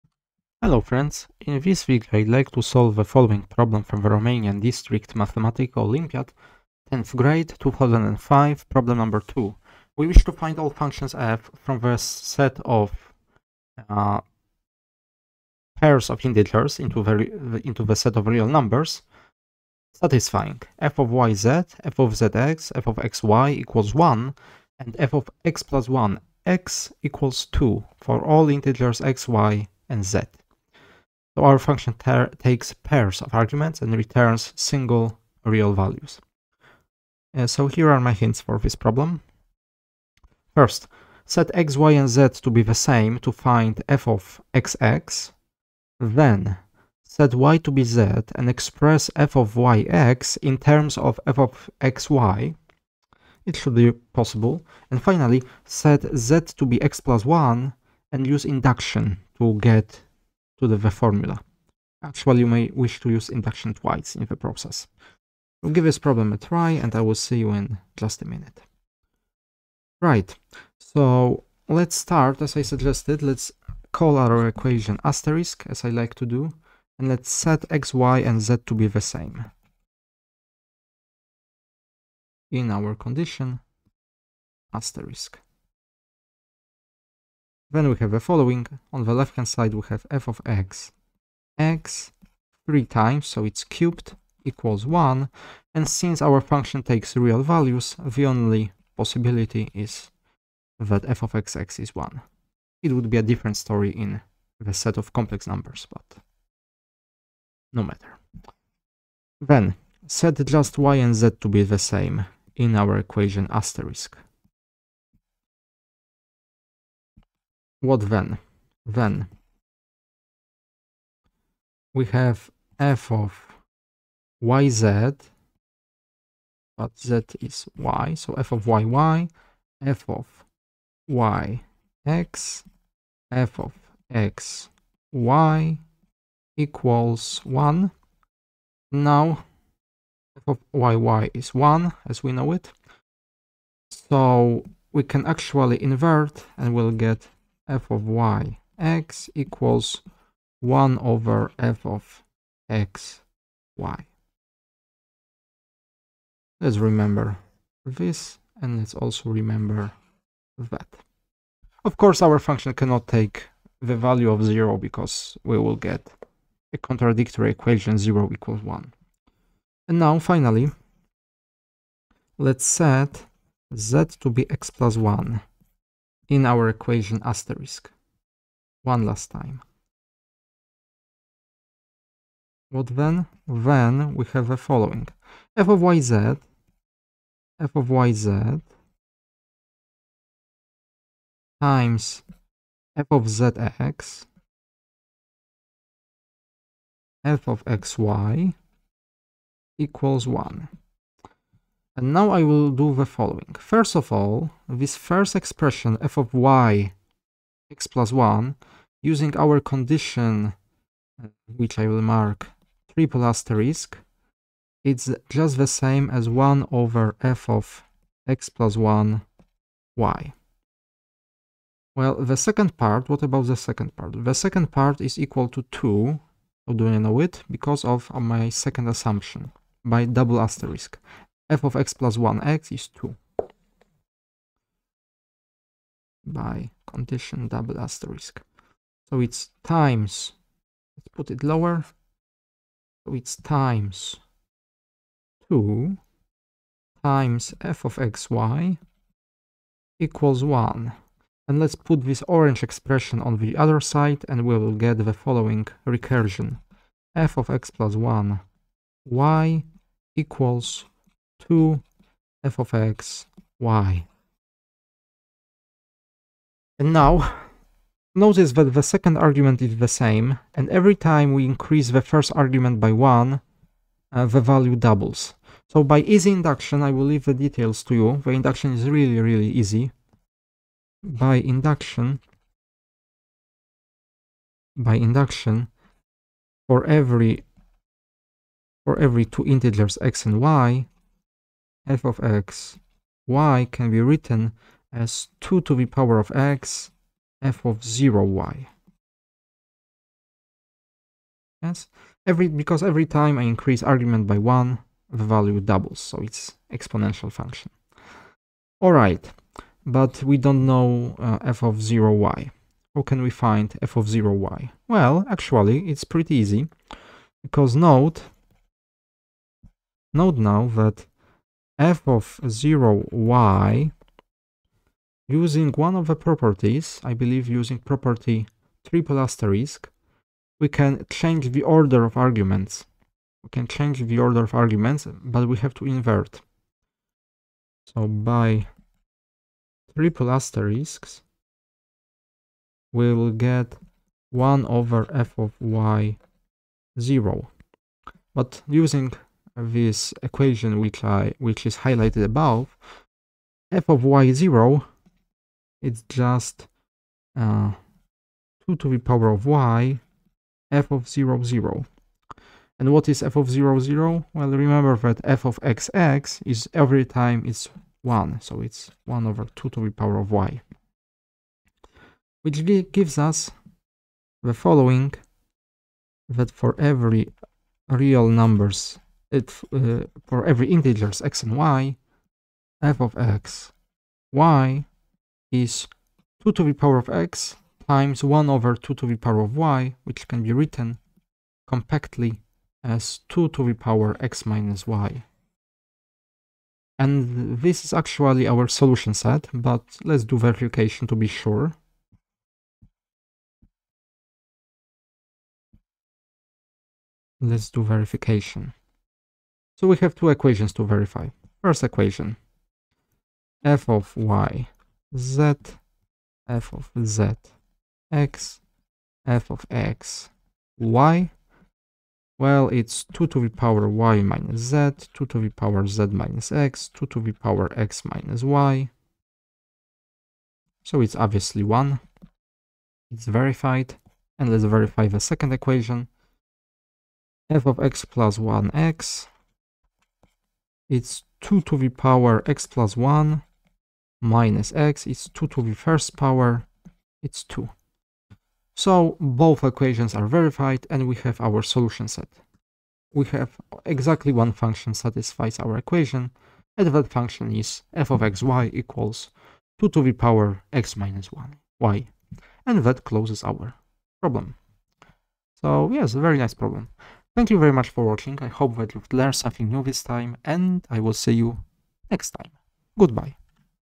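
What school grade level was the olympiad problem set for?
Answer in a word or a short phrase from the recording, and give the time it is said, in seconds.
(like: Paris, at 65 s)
10th grade, at 6 s.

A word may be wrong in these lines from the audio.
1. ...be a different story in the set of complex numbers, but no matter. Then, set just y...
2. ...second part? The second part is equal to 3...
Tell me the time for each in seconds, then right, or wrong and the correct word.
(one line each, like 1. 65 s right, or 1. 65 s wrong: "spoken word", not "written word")
1. 103 s right
2. 223 s wrong: "2", not "3".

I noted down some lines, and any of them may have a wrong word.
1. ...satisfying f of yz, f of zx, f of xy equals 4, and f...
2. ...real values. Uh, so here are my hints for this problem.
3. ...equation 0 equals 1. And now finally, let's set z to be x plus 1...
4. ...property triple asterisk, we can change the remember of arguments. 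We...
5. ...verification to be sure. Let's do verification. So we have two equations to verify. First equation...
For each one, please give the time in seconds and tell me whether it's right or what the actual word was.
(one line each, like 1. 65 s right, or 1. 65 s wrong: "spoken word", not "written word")
1. 19 s wrong: "1", not "4"
2. 35 s right
3. 167 s right
4. 327 s wrong: "order", not "remember"
5. 400 s right.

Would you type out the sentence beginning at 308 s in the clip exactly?
All right, but we don't know uh, f of 0 y.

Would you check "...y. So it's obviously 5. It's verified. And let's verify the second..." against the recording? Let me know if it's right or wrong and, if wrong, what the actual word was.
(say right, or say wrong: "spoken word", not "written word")
wrong: "1", not "5".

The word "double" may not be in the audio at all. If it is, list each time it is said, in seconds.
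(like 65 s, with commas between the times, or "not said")
230 s, 237 s, 274 s, 305 s.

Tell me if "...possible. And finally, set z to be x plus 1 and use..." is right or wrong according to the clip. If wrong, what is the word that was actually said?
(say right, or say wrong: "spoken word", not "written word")
right.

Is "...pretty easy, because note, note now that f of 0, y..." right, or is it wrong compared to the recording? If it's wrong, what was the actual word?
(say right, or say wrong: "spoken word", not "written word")
right.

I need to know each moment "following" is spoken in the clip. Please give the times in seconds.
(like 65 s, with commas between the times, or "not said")
3 s, 88 s, 184 s, 203 s, 255 s, 374 s.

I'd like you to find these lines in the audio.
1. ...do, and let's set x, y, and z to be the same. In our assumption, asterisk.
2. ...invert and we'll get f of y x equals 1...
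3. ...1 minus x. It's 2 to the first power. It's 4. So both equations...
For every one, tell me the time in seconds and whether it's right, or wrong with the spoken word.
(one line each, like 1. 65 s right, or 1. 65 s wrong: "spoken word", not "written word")
1. 76 s wrong: "condition", not "assumption"
2. 145 s right
3. 442 s wrong: "2", not "4".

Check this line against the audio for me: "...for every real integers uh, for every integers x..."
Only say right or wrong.
wrong.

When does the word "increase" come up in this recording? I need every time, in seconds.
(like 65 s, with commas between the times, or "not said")
271 s, 303 s.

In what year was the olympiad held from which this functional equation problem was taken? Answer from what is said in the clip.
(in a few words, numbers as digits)
2005.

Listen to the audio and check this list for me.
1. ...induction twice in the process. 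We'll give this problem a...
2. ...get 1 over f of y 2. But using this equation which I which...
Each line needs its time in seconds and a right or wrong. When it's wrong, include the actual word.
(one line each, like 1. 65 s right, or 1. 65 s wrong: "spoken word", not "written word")
1. 63 s right
2. 343 s wrong: "0", not "2".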